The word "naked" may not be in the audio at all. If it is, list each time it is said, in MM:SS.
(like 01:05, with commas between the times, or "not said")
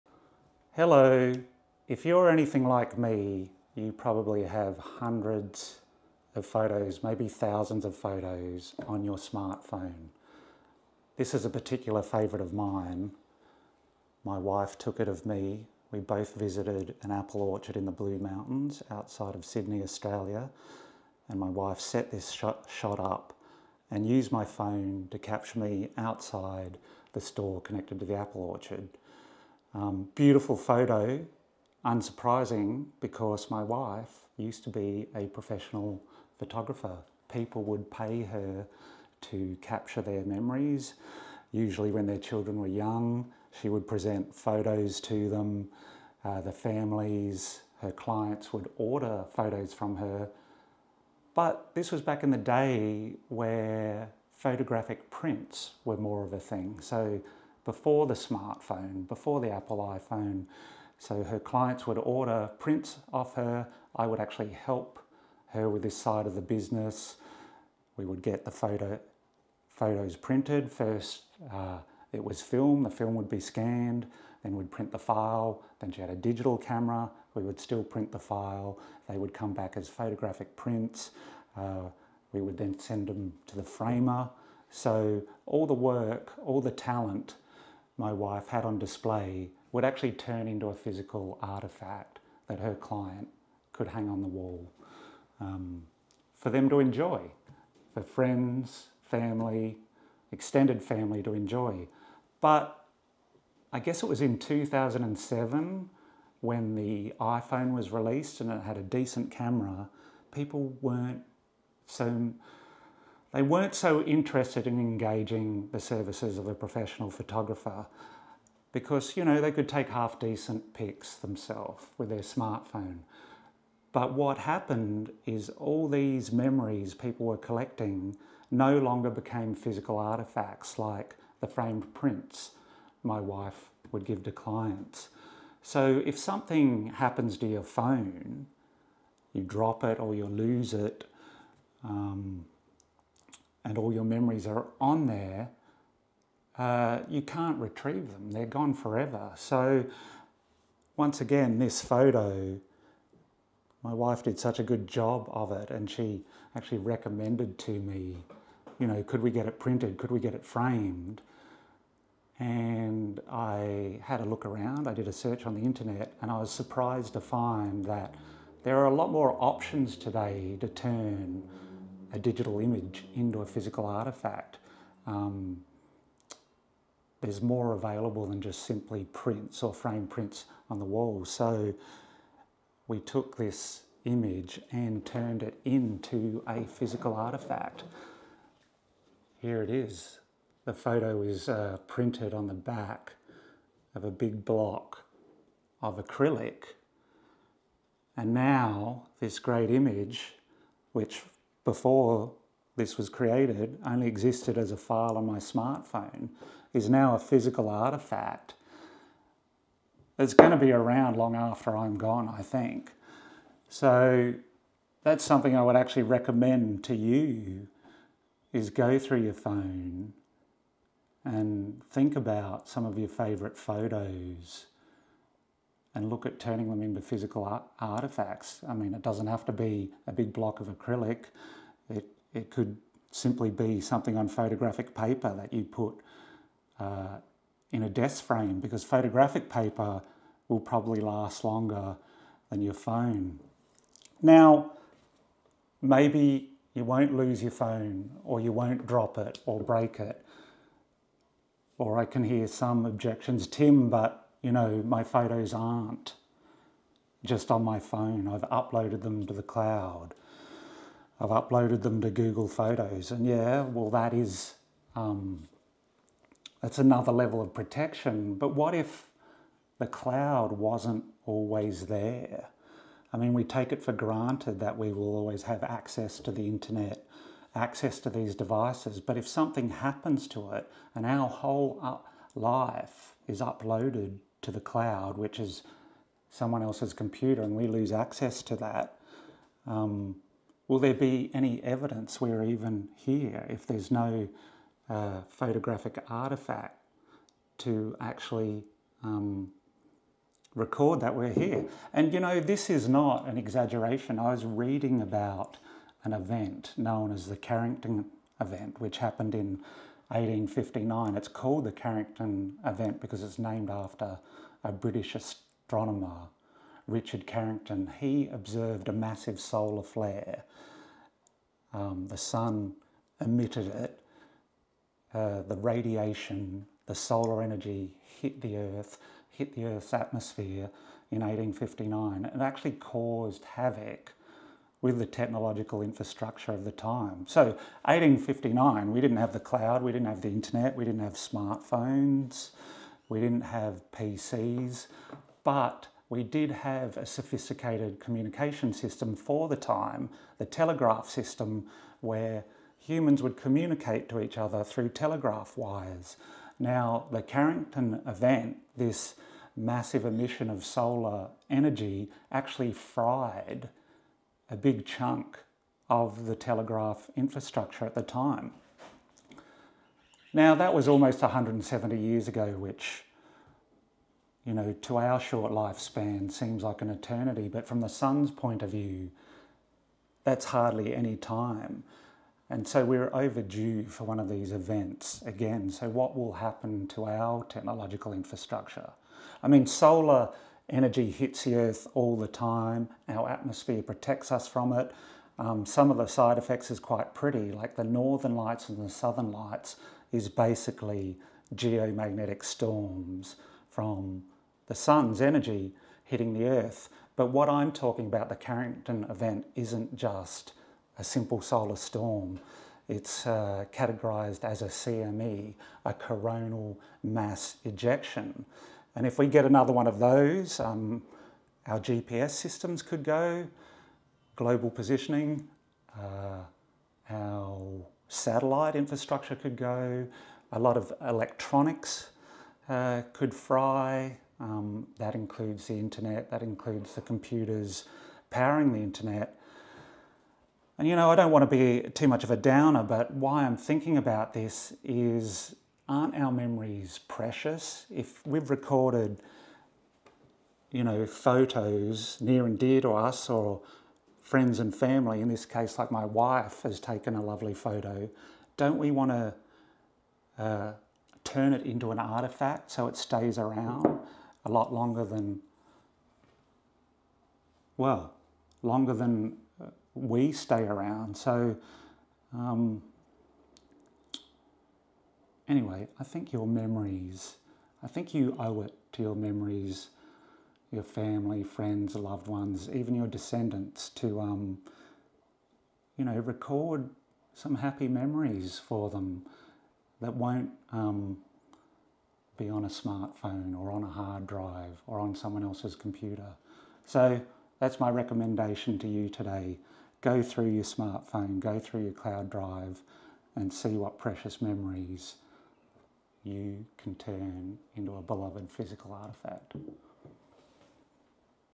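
not said.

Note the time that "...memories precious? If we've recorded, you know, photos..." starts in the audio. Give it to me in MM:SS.
07:26.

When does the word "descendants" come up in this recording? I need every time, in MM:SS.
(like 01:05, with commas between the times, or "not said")
08:03.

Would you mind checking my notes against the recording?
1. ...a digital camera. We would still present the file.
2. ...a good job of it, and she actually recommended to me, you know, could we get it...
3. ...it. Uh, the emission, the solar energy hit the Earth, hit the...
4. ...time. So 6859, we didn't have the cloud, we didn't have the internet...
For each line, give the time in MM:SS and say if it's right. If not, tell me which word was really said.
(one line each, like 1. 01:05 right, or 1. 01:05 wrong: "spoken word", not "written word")
1. 01:16 wrong: "print", not "present"
2. 02:34 right
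3. 05:23 wrong: "radiation", not "emission"
4. 05:36 wrong: "1859", not "6859".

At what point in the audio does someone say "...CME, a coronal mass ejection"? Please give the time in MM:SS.
06:54.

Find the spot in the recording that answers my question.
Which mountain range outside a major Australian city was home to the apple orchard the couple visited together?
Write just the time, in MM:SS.
00:17.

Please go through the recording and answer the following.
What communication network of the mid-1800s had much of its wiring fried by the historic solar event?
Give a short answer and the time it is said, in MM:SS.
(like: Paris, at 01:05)
telegraph system, at 05:50.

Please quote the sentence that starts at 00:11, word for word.
This is a particular favourite of mine.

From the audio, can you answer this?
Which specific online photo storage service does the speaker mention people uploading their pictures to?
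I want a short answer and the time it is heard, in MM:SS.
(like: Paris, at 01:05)
Google Photos, at 04:22.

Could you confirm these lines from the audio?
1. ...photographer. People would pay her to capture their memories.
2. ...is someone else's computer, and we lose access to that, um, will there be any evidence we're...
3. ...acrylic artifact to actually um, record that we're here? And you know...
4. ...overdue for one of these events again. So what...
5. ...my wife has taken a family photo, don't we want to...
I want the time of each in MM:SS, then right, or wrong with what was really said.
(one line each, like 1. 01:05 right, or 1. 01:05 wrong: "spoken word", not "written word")
1. 00:36 right
2. 04:45 right
3. 04:55 wrong: "photographic", not "acrylic"
4. 06:23 right
5. 07:35 wrong: "lovely", not "family".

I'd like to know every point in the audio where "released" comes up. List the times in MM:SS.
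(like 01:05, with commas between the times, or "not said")
01:47.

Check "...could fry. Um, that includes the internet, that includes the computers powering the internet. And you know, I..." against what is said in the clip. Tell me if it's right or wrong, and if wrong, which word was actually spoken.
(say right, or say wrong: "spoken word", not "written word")
right.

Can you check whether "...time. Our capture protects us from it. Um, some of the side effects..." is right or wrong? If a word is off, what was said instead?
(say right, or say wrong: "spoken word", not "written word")
wrong: "atmosphere", not "capture".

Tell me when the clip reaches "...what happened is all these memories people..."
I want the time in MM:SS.
02:04.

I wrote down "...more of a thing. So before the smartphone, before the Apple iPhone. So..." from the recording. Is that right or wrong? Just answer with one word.
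right.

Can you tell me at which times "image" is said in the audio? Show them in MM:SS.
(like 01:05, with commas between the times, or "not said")
02:52, 03:04, 03:19.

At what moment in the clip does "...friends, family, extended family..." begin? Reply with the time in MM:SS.
01:38.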